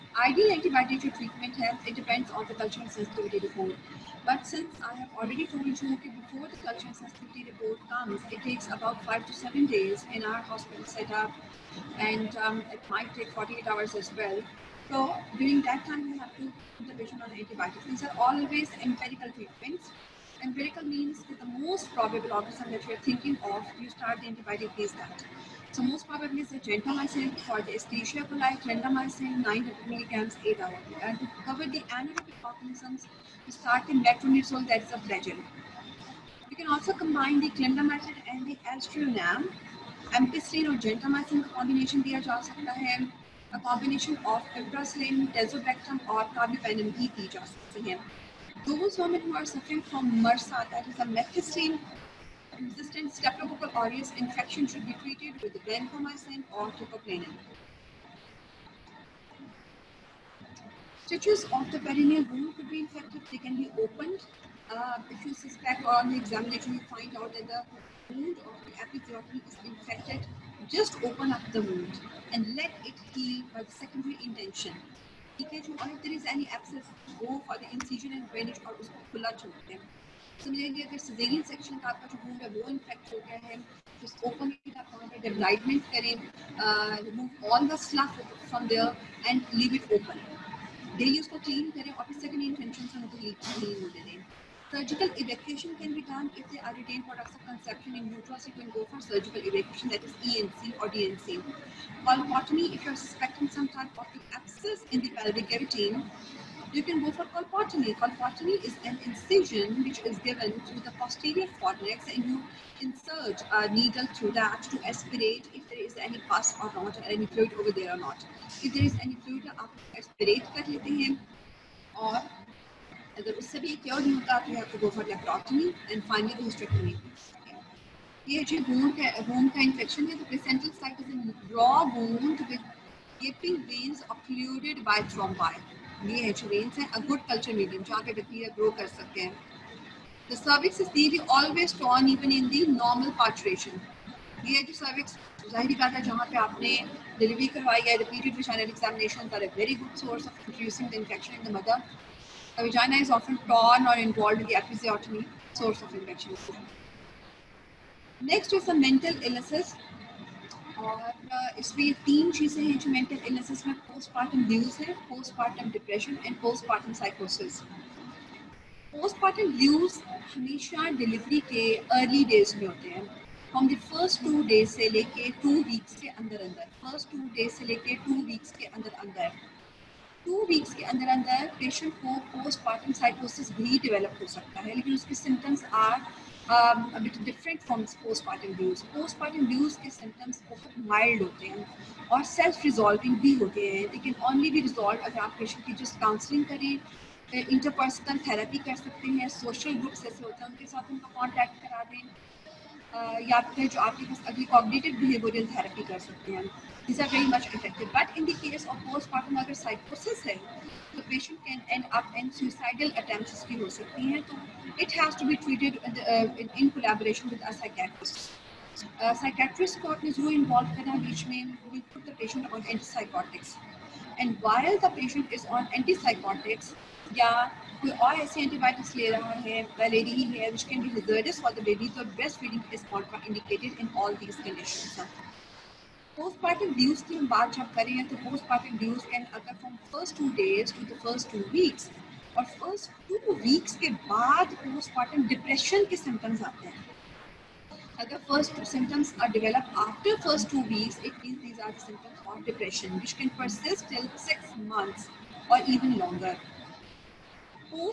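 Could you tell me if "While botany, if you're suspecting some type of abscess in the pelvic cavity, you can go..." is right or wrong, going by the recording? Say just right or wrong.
right.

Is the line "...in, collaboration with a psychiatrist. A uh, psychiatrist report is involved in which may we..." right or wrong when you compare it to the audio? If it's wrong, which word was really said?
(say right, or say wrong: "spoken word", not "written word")
wrong: "court", not "report".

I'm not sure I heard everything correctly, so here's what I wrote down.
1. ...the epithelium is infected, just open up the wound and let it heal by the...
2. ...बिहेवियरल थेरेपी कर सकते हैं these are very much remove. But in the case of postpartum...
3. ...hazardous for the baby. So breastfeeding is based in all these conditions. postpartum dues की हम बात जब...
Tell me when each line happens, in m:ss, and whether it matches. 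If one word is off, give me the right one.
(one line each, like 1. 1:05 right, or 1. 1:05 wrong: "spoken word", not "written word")
1. 1:08 right
2. 3:25 wrong: "effective", not "remove"
3. 3:50 wrong: "indicated", not "based".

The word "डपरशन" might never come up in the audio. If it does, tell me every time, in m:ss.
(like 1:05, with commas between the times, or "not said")
2:45, 4:05.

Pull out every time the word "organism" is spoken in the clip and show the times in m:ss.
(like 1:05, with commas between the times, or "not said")
0:22, 0:32.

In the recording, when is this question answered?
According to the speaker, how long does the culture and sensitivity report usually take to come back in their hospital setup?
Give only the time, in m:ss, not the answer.
0:09.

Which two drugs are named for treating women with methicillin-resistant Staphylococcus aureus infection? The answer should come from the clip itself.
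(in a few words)
vancomycin or teicoplanin.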